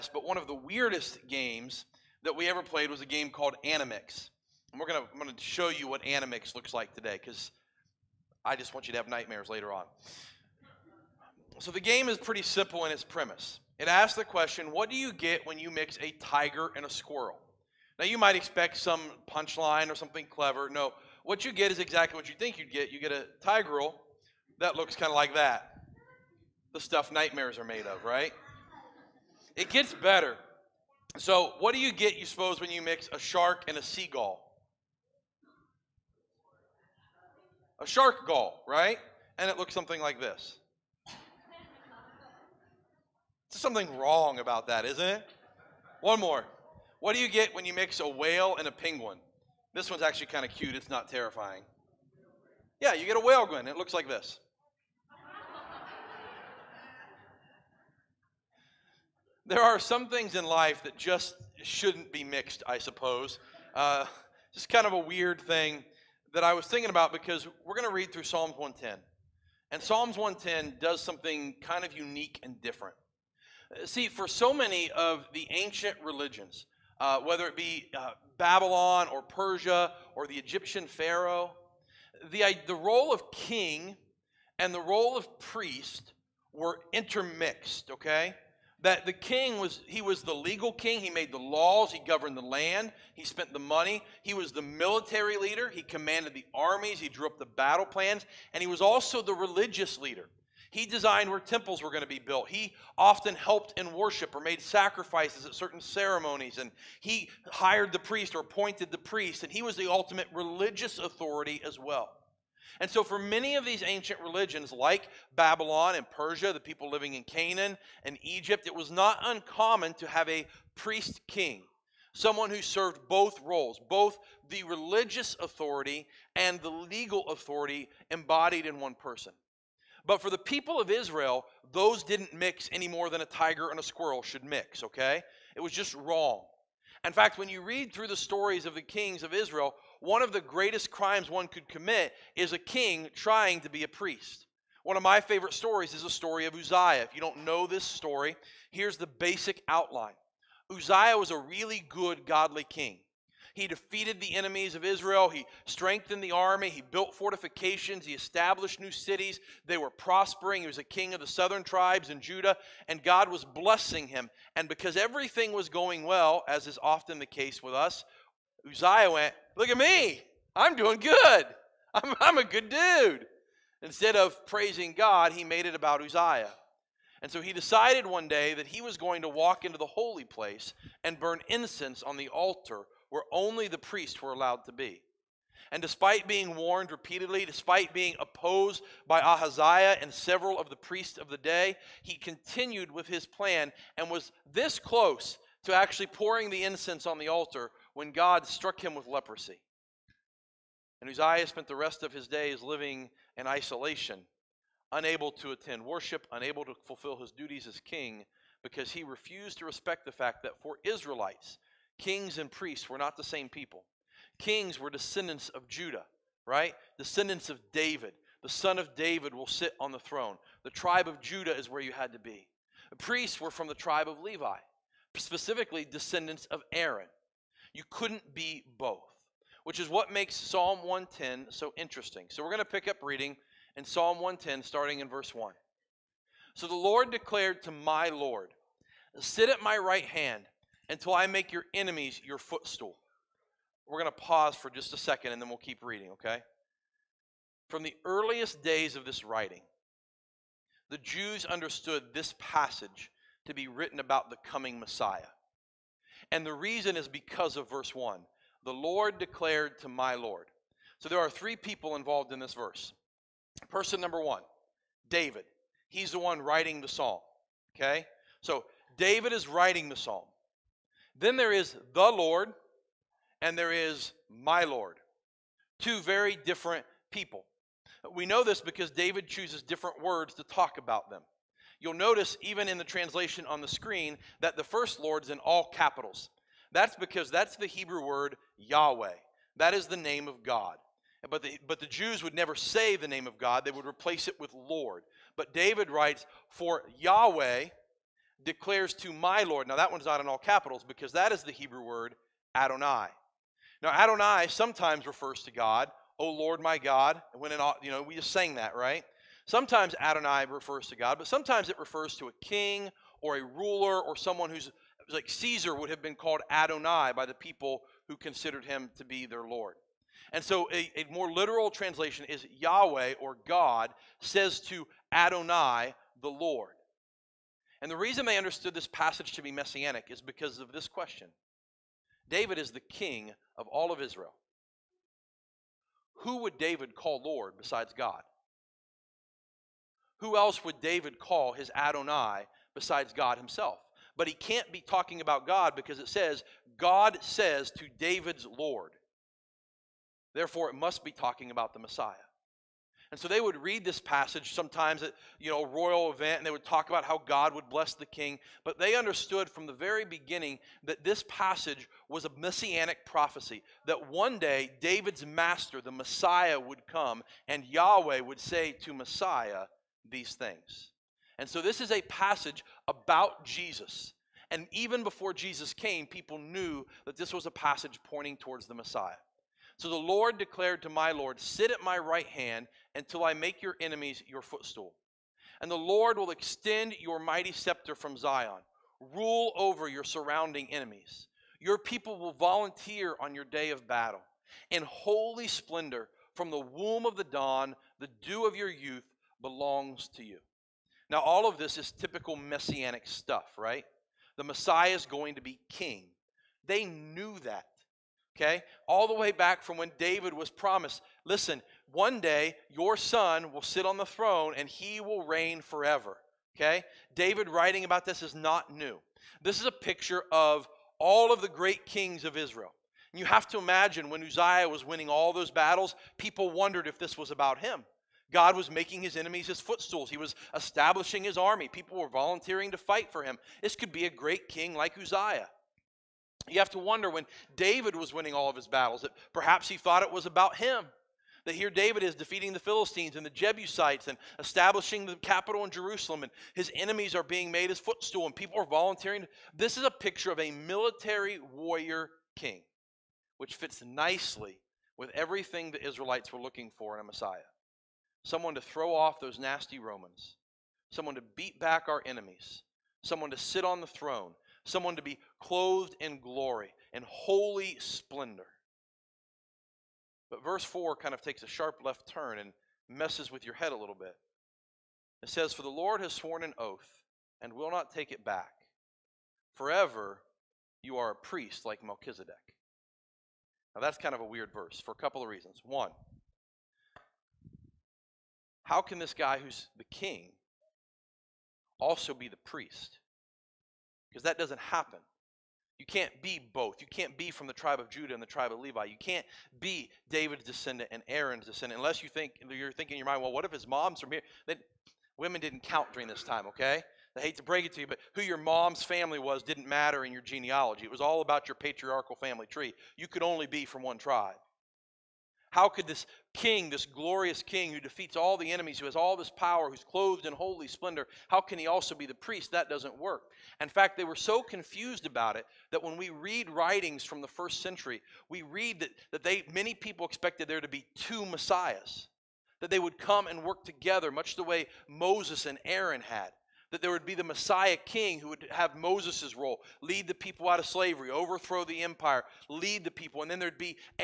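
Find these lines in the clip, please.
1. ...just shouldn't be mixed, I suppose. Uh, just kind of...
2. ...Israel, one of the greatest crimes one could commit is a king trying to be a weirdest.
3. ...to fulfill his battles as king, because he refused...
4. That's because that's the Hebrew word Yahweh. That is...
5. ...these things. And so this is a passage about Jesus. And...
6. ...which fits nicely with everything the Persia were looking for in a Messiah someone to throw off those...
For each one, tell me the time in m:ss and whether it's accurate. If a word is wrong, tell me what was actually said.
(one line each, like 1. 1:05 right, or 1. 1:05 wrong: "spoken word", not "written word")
1. 1:00 right
2. 2:19 wrong: "priest", not "weirdest"
3. 3:26 wrong: "duties", not "battles"
4. 4:46 right
5. 6:10 right
6. 7:33 wrong: "Israelites", not "Persia".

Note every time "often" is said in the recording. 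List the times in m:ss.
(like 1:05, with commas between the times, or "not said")
1:42, 2:46.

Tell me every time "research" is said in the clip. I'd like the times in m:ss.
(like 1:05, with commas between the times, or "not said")
not said.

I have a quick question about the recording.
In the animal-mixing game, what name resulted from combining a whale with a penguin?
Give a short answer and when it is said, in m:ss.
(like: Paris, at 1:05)
whale gun, at 0:53.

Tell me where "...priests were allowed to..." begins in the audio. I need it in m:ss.
3:03.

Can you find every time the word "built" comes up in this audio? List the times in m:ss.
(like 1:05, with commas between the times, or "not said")
1:42, 2:36.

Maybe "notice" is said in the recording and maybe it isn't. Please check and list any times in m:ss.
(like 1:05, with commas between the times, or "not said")
4:41.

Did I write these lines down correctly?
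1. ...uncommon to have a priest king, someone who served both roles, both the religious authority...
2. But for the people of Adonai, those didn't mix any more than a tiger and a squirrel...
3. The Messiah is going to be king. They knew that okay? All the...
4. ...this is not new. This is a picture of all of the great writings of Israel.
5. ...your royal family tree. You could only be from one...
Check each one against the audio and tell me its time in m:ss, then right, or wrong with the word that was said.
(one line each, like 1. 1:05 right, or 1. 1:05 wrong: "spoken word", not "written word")
1. 1:59 right
2. 2:10 wrong: "Israel", not "Adonai"
3. 6:44 right
4. 6:58 wrong: "kings", not "writings"
5. 8:31 wrong: "patriarchal", not "royal".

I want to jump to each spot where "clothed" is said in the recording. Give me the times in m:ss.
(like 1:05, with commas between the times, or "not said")
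7:45, 8:39.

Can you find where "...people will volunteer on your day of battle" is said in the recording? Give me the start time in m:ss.
6:31.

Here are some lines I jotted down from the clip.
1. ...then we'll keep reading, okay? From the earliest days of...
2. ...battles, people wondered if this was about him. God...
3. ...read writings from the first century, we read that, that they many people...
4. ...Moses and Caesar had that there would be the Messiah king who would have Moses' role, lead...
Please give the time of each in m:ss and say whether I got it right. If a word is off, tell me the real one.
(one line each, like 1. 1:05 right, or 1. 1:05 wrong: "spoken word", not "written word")
1. 4:05 right
2. 7:05 right
3. 8:46 right
4. 8:54 wrong: "Aaron", not "Caesar".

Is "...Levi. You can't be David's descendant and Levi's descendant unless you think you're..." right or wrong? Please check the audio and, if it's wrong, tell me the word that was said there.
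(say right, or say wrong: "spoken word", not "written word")
wrong: "Aaron", not "Levi".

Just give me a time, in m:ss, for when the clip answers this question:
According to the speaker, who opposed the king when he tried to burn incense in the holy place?
3:09.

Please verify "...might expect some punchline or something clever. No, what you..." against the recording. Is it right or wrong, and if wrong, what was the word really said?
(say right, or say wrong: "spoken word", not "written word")
right.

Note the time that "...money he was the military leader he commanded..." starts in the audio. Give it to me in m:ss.
1:33.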